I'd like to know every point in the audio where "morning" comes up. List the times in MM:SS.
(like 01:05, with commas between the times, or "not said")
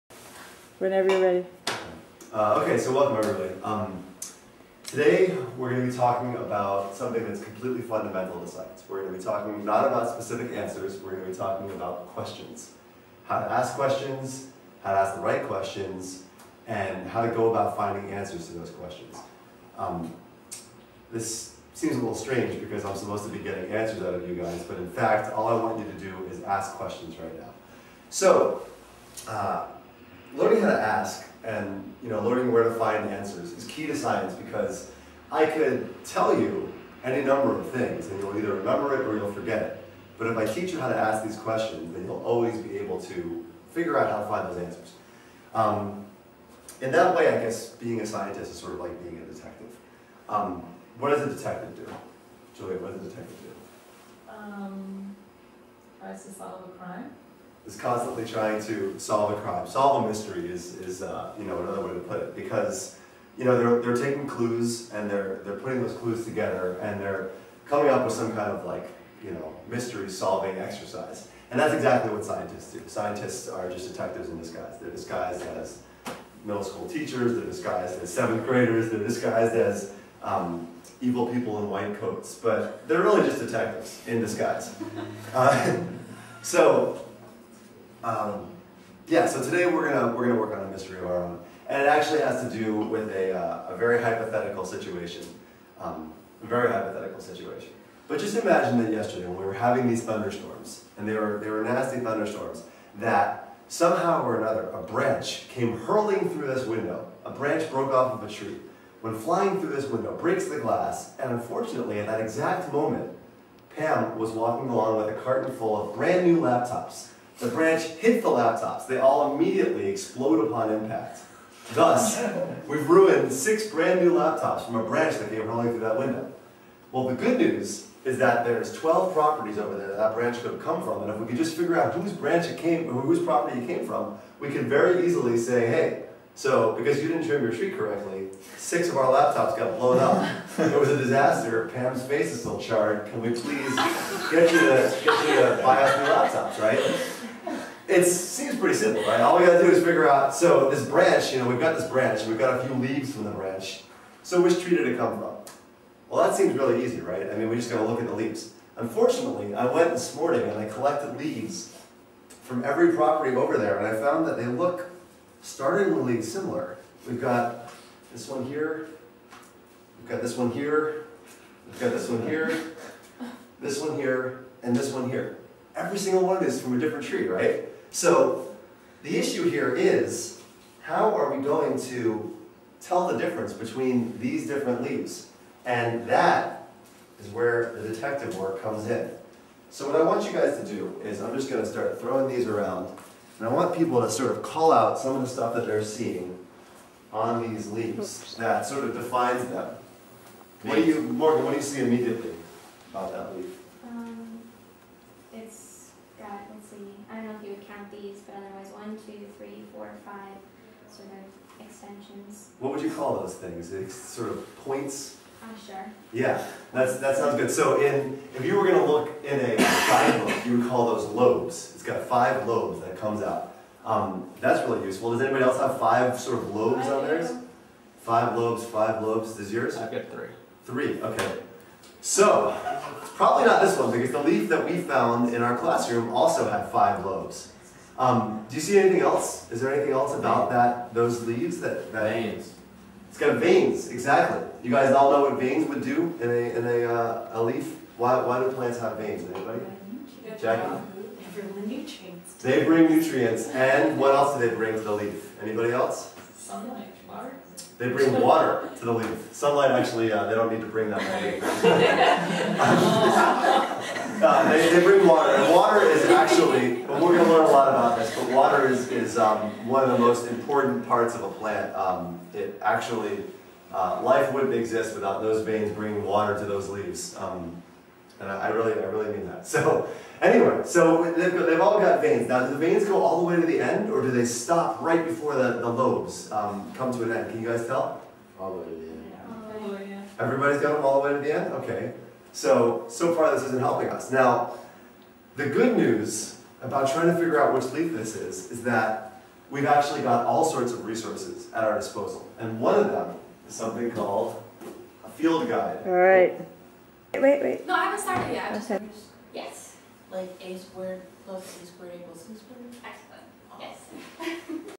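02:40.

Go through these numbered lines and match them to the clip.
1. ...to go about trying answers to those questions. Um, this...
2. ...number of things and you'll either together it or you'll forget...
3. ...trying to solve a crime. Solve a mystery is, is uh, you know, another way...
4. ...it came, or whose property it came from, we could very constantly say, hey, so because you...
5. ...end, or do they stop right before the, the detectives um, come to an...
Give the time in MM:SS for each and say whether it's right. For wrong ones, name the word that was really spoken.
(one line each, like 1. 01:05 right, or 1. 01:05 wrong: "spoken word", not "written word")
1. 00:17 wrong: "finding", not "trying"
2. 00:37 wrong: "remember", not "together"
3. 00:58 right
4. 02:12 wrong: "easily", not "constantly"
5. 04:43 wrong: "lobes", not "detectives".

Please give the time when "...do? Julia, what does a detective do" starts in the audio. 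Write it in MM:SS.
00:51.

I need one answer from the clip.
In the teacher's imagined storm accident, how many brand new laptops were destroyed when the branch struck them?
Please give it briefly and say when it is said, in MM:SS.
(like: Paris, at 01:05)
6, at 02:03.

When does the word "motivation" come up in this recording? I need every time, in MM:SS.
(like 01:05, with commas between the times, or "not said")
not said.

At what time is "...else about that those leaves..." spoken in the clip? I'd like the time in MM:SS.
03:59.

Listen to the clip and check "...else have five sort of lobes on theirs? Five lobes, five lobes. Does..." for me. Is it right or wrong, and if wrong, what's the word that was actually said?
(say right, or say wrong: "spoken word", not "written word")
right.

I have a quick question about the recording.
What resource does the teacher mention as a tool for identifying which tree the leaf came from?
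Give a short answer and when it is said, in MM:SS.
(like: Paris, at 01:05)
field guide, at 05:05.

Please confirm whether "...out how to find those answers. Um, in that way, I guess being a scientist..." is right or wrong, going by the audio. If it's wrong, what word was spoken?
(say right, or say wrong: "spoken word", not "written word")
right.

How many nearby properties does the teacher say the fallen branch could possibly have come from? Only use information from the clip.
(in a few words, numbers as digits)
12.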